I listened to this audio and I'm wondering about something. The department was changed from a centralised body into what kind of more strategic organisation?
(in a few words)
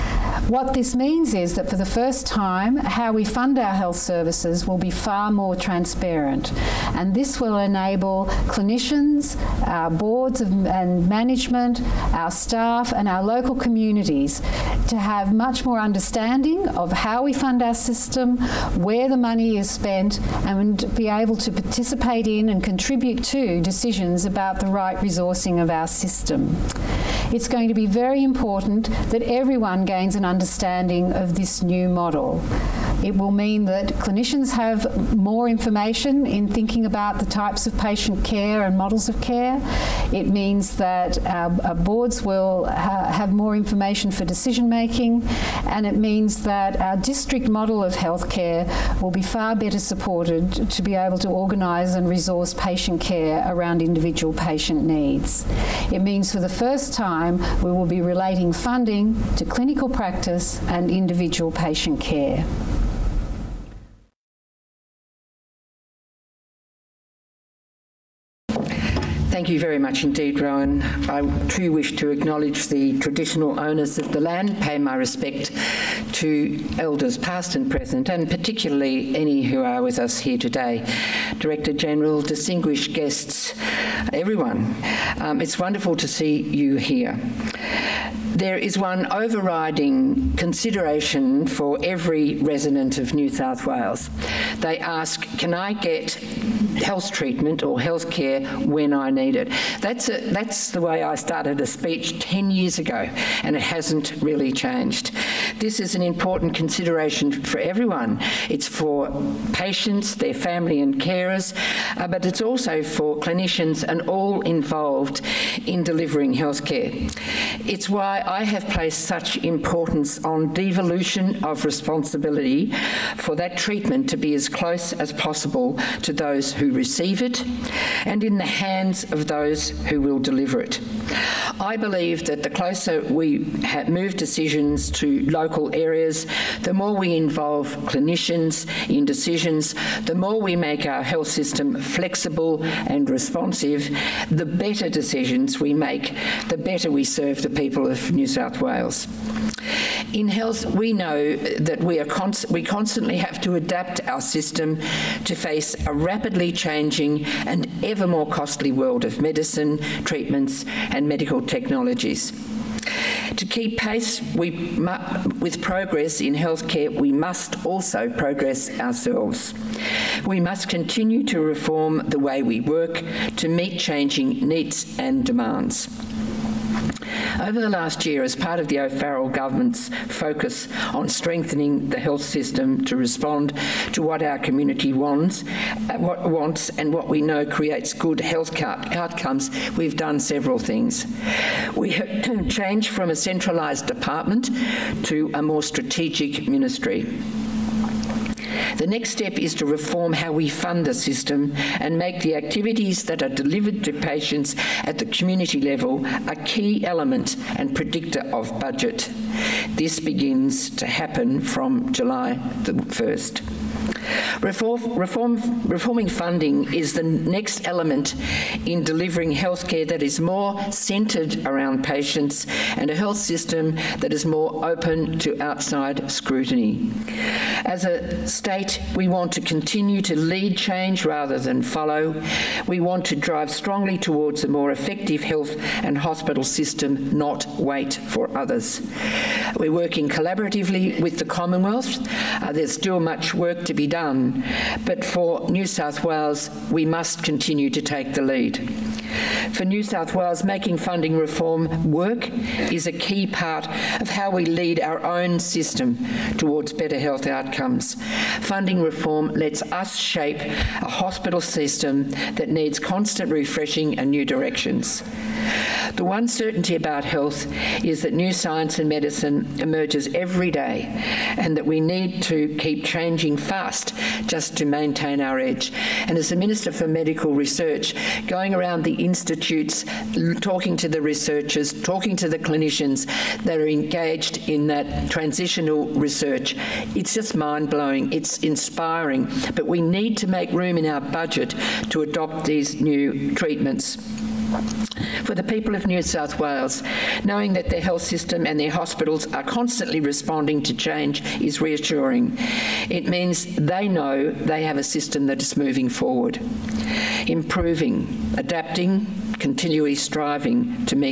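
Ministry.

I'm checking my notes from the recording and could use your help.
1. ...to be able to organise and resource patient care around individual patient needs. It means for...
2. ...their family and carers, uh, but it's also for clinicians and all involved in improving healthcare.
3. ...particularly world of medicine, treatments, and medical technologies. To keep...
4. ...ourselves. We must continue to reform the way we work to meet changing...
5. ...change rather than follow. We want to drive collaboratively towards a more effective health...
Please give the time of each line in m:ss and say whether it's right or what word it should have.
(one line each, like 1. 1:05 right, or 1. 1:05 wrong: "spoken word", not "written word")
1. 0:50 right
2. 1:50 wrong: "delivering", not "improving"
3. 2:38 wrong: "costly", not "particularly"
4. 2:48 right
5. 3:50 wrong: "strongly", not "collaboratively".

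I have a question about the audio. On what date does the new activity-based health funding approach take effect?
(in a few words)
July 1.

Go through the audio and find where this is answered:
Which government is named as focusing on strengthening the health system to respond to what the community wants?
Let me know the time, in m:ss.
2:58.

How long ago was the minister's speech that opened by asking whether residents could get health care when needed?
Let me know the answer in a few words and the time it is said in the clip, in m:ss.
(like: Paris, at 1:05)
10 years ago, at 1:42.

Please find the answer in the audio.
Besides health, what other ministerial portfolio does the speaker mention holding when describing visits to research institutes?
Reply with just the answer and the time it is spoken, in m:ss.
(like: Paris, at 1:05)
Medical Research, at 4:36.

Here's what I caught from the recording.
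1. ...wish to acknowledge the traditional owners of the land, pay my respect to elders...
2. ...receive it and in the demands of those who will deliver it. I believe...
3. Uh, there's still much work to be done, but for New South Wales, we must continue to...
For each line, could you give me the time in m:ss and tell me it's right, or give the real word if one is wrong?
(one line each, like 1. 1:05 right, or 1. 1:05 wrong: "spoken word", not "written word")
1. 1:11 right
2. 2:06 wrong: "hands", not "demands"
3. 4:02 right.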